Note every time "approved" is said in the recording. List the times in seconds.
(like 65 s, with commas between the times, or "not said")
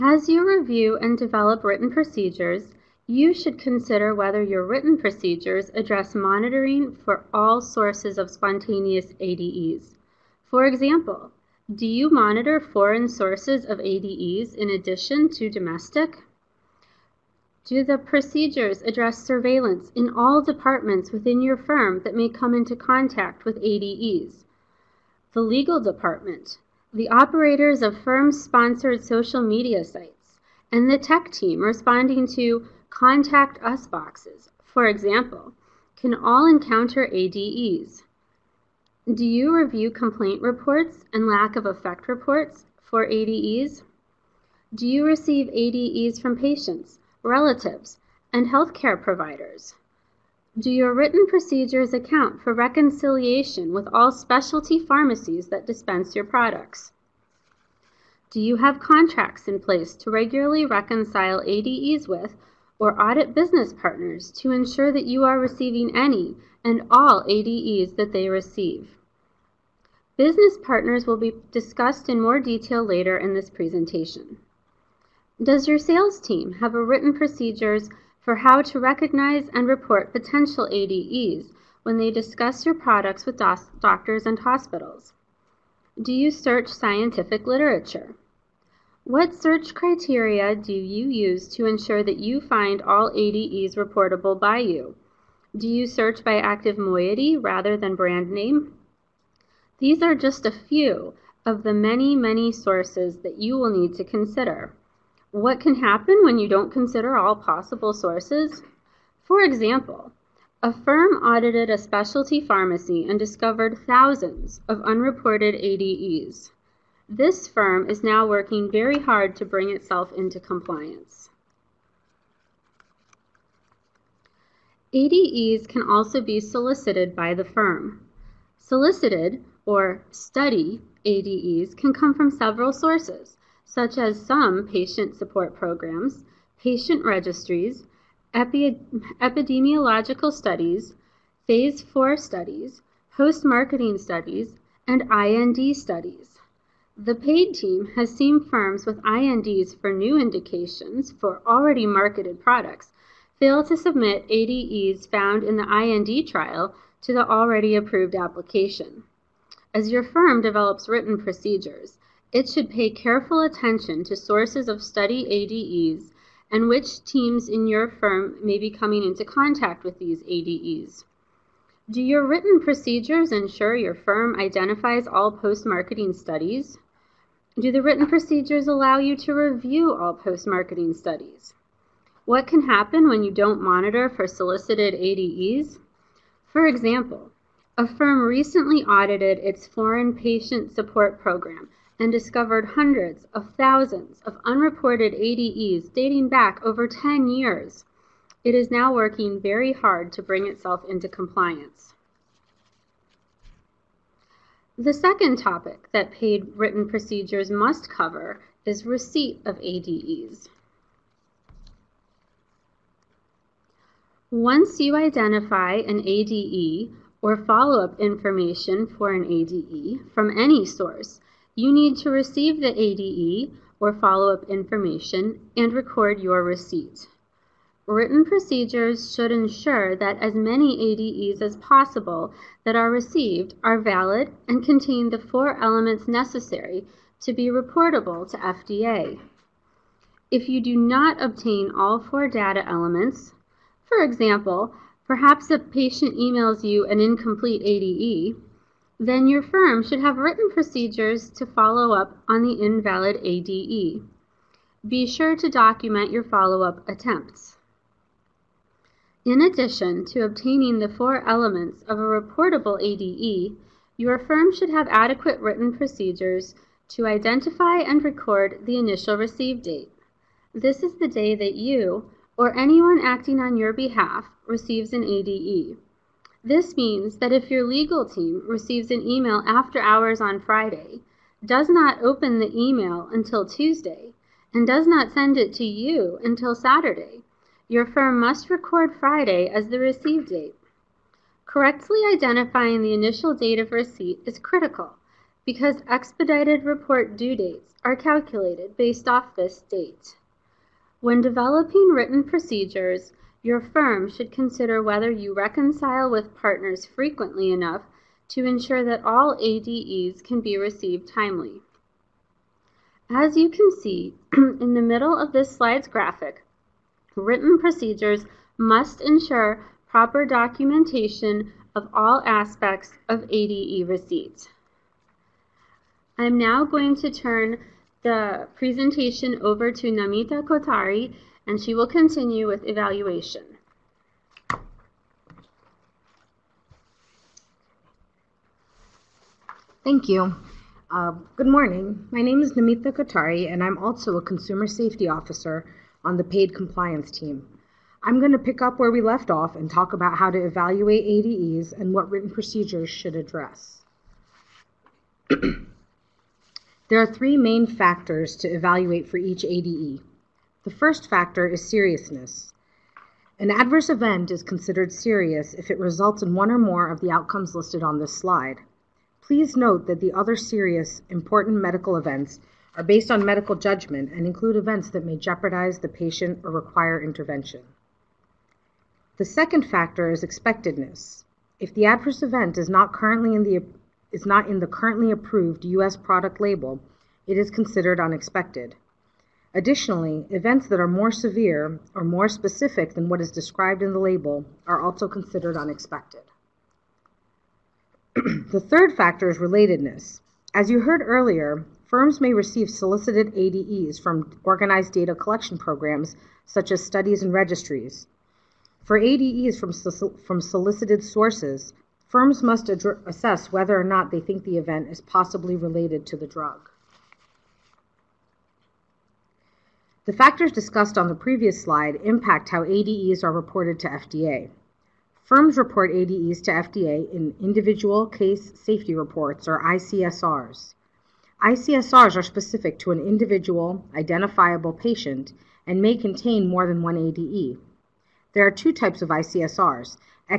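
157 s, 385 s.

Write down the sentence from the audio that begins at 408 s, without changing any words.
For ADEs from, from solicited sources, firms must assess whether or not they think the event is possibly related to the drug.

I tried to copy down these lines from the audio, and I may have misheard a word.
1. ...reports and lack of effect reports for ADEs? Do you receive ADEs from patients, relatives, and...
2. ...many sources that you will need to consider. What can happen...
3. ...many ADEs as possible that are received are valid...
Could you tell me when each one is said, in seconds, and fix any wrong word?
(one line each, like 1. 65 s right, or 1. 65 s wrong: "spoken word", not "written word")
1. 40 s right
2. 102 s right
3. 230 s right.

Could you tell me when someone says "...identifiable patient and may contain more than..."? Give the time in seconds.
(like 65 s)
433 s.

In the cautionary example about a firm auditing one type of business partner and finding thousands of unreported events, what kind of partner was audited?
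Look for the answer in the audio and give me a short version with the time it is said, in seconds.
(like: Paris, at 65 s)
specialty pharmacy, at 111 s.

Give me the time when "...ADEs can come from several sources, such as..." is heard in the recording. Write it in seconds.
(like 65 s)
131 s.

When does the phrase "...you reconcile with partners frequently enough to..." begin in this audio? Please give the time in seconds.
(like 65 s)
305 s.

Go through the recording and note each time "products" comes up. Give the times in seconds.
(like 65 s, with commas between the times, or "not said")
56 s, 82 s, 152 s, 385 s.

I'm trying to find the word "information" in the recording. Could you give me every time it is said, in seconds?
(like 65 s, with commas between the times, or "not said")
218 s, 224 s.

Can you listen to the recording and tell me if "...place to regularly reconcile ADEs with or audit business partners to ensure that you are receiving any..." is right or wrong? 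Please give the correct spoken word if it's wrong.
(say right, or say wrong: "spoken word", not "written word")
right.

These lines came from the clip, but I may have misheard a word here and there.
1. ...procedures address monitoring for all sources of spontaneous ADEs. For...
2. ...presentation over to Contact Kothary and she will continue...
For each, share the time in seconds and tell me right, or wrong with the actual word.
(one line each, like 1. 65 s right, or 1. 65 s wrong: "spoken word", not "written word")
1. 4 s right
2. 328 s wrong: "Namita", not "Contact".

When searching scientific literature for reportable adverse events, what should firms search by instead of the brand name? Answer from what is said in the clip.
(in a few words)
active moiety.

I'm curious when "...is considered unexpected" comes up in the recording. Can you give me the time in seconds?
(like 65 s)
387 s.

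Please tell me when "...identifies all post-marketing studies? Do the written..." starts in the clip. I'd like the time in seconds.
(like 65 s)
174 s.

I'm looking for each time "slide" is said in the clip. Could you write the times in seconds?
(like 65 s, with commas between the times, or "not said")
315 s, 368 s, 421 s.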